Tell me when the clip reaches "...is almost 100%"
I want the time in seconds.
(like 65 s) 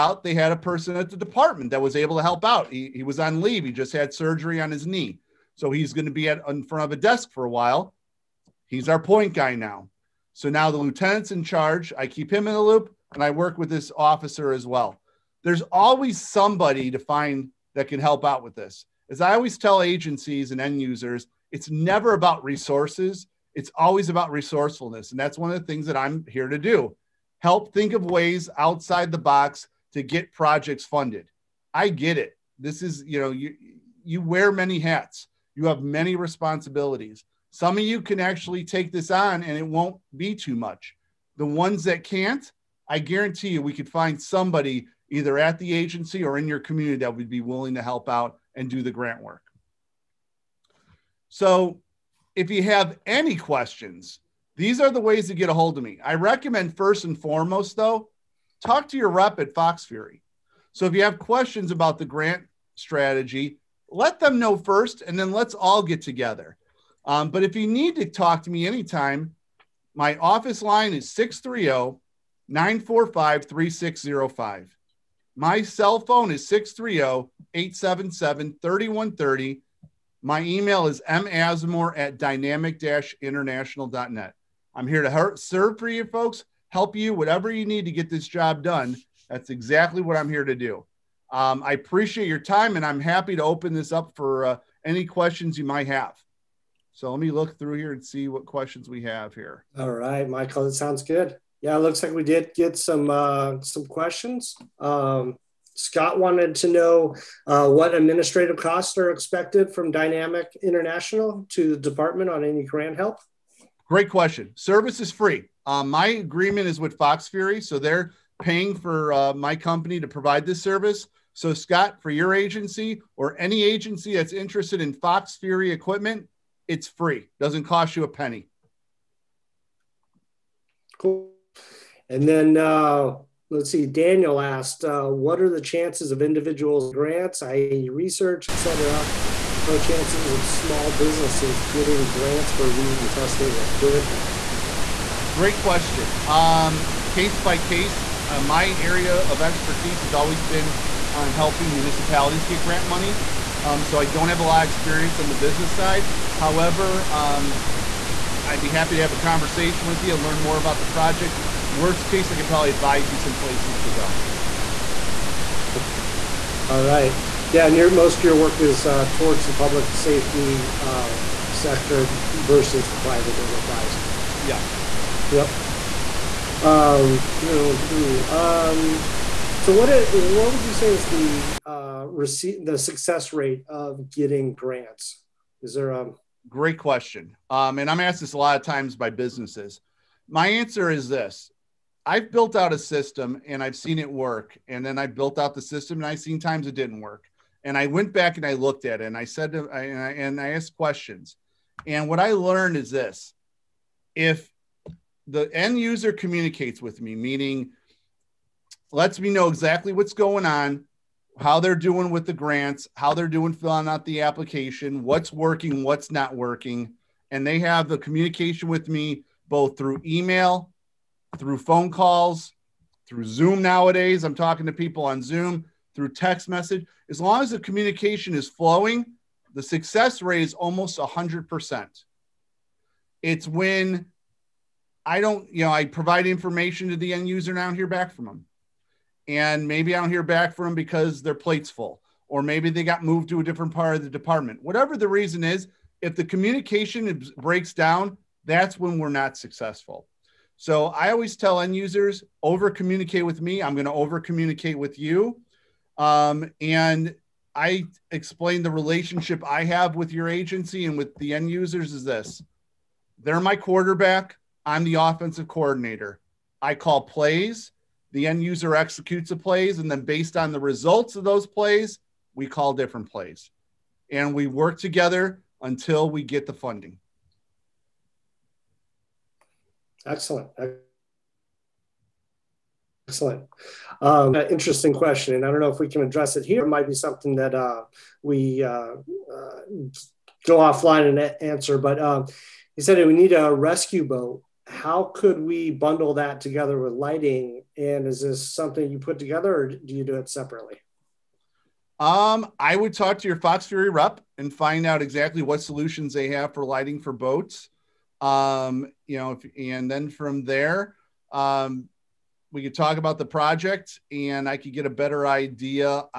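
230 s.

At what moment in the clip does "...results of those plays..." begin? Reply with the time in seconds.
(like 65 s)
270 s.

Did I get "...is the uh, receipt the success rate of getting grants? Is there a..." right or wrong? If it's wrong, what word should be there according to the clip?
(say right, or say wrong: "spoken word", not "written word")
right.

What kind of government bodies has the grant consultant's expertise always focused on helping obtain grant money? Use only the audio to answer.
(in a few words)
municipalities.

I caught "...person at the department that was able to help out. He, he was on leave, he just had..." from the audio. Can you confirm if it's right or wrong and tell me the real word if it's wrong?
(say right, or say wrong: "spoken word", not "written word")
right.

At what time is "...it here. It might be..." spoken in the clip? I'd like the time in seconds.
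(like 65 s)
286 s.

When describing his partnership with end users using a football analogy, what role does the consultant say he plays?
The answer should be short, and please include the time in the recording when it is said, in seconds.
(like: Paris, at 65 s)
offensive coordinator, at 264 s.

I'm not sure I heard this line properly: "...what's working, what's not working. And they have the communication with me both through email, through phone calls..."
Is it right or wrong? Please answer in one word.
right.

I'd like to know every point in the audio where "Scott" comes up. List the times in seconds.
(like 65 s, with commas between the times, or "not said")
105 s, 121 s.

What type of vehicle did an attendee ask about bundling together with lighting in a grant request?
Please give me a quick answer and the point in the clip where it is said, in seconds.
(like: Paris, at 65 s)
rescue boat, at 293 s.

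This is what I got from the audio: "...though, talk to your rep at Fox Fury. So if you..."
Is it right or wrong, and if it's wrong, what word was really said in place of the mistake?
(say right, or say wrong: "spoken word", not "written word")
right.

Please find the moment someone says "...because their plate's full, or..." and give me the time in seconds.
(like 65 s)
240 s.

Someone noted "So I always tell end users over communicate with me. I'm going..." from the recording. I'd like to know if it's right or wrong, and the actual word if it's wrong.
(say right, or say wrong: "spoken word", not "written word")
right.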